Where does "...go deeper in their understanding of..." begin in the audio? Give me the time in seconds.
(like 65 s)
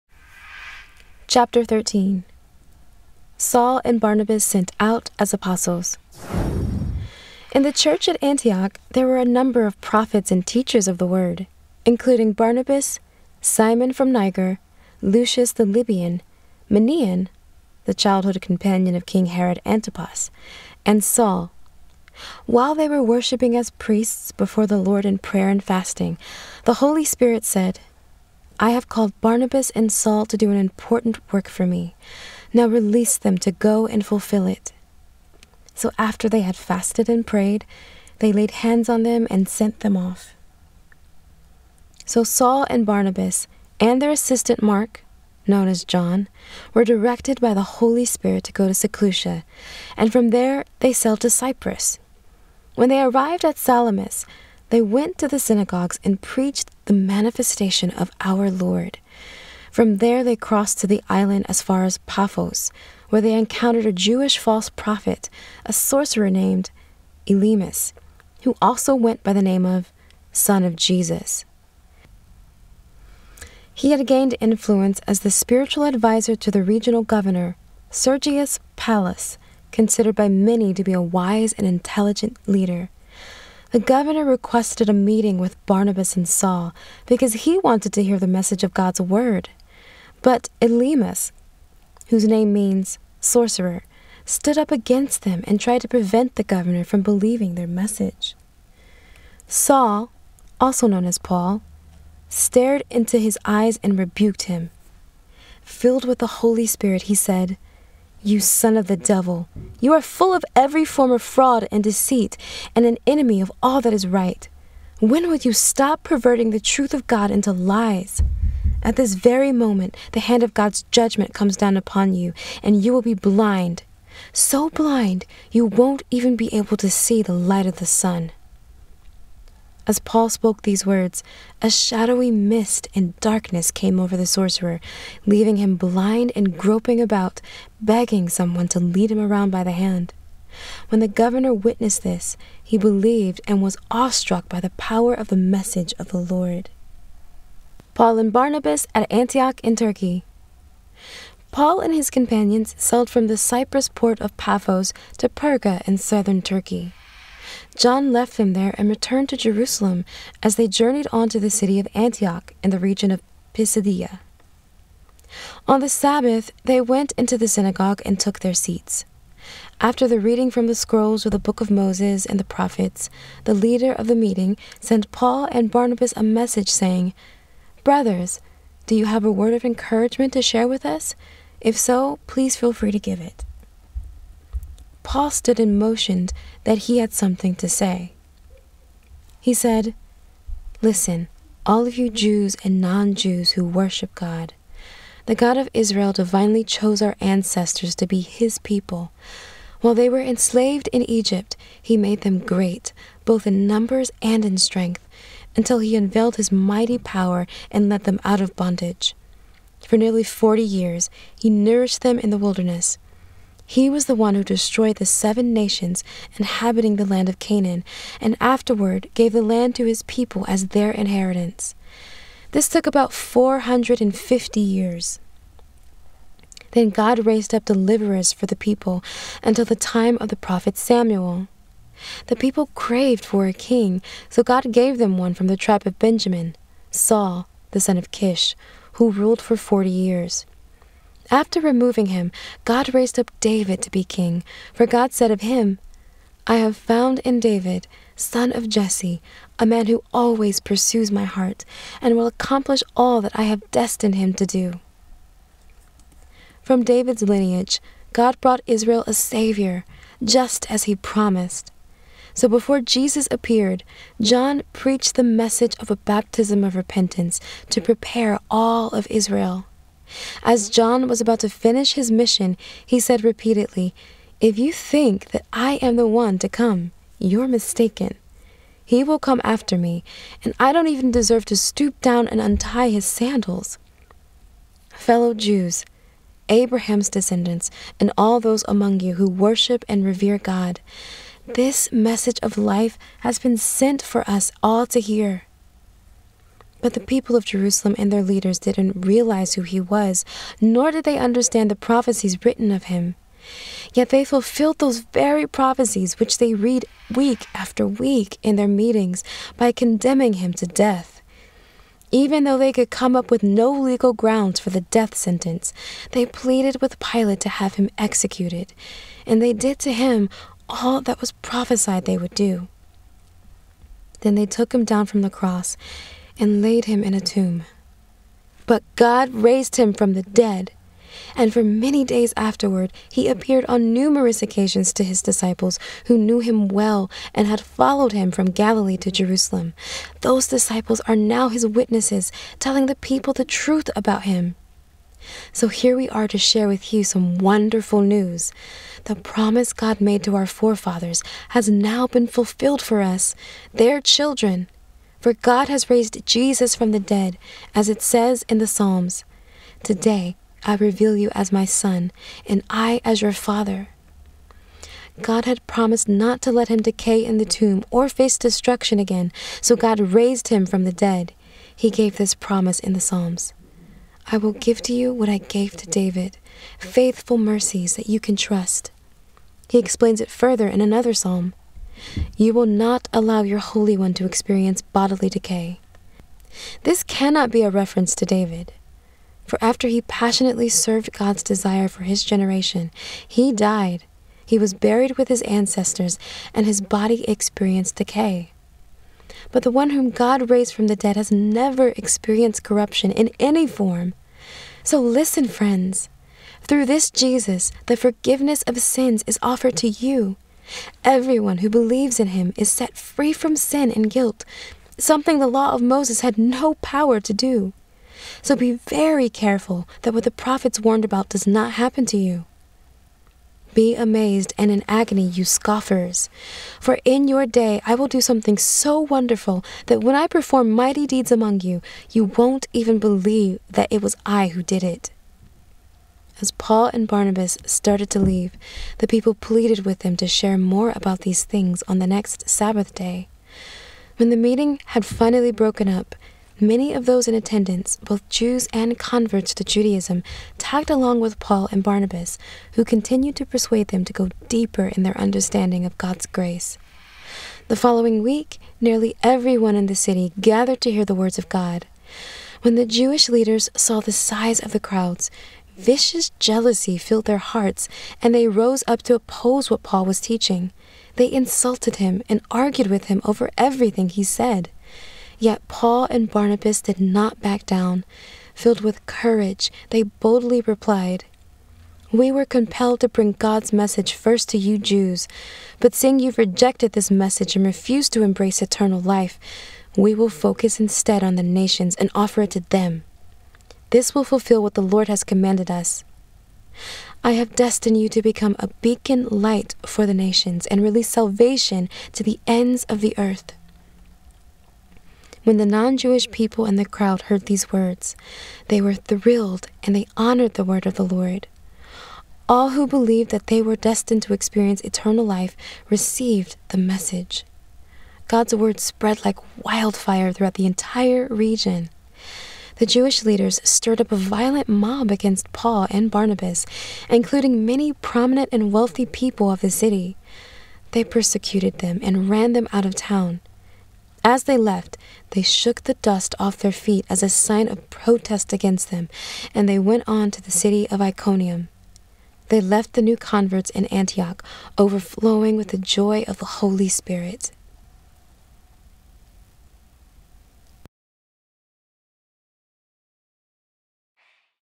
454 s.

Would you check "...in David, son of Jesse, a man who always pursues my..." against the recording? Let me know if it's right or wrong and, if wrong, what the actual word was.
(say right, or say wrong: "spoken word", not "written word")
right.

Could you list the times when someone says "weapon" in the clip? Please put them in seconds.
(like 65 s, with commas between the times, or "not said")
not said.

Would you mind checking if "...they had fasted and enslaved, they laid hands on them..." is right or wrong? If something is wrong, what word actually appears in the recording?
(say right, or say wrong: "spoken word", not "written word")
wrong: "prayed", not "enslaved".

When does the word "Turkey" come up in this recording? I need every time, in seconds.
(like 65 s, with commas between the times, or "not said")
149 s, 156 s.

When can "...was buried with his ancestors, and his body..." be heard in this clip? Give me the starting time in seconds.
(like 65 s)
394 s.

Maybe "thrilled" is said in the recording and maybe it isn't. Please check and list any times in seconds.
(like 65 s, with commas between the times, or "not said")
508 s.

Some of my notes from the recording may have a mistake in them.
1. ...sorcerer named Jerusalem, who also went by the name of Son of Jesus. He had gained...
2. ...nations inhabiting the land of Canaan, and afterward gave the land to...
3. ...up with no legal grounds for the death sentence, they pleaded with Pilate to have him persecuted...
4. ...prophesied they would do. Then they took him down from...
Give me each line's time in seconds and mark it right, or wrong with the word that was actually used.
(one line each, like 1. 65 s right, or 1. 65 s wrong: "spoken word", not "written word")
1. 65 s wrong: "Elymas", not "Jerusalem"
2. 215 s right
3. 313 s wrong: "executed", not "persecuted"
4. 321 s right.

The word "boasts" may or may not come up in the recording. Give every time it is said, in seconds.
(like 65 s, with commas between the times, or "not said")
not said.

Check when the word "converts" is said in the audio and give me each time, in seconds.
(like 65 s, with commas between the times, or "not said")
448 s, 543 s.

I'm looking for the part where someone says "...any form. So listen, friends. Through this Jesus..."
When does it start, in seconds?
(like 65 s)
403 s.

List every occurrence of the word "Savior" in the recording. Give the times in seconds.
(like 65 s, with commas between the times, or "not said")
259 s.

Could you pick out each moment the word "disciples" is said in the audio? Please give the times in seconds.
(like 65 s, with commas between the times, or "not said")
335 s, 340 s.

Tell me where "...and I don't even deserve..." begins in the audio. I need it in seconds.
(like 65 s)
280 s.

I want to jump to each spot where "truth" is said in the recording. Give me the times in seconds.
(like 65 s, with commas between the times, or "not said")
116 s, 343 s.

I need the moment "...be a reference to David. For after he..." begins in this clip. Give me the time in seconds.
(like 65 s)
387 s.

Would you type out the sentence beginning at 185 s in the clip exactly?
Paul stood and motioned that he had something to say.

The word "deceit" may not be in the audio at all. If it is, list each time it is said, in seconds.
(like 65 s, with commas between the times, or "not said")
111 s.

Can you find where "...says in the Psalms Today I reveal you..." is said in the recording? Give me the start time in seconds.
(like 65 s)
358 s.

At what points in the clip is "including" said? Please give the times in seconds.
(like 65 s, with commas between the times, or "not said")
11 s, 527 s.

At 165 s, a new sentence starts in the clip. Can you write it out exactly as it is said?
On the Sabbath, they went into the synagogue and took their seats.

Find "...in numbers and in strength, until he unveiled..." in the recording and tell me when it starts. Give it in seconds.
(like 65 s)
203 s.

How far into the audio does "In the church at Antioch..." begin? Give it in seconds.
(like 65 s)
7 s.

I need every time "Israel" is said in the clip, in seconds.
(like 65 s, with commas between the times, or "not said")
195 s, 258 s, 269 s.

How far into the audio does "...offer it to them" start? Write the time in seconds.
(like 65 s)
492 s.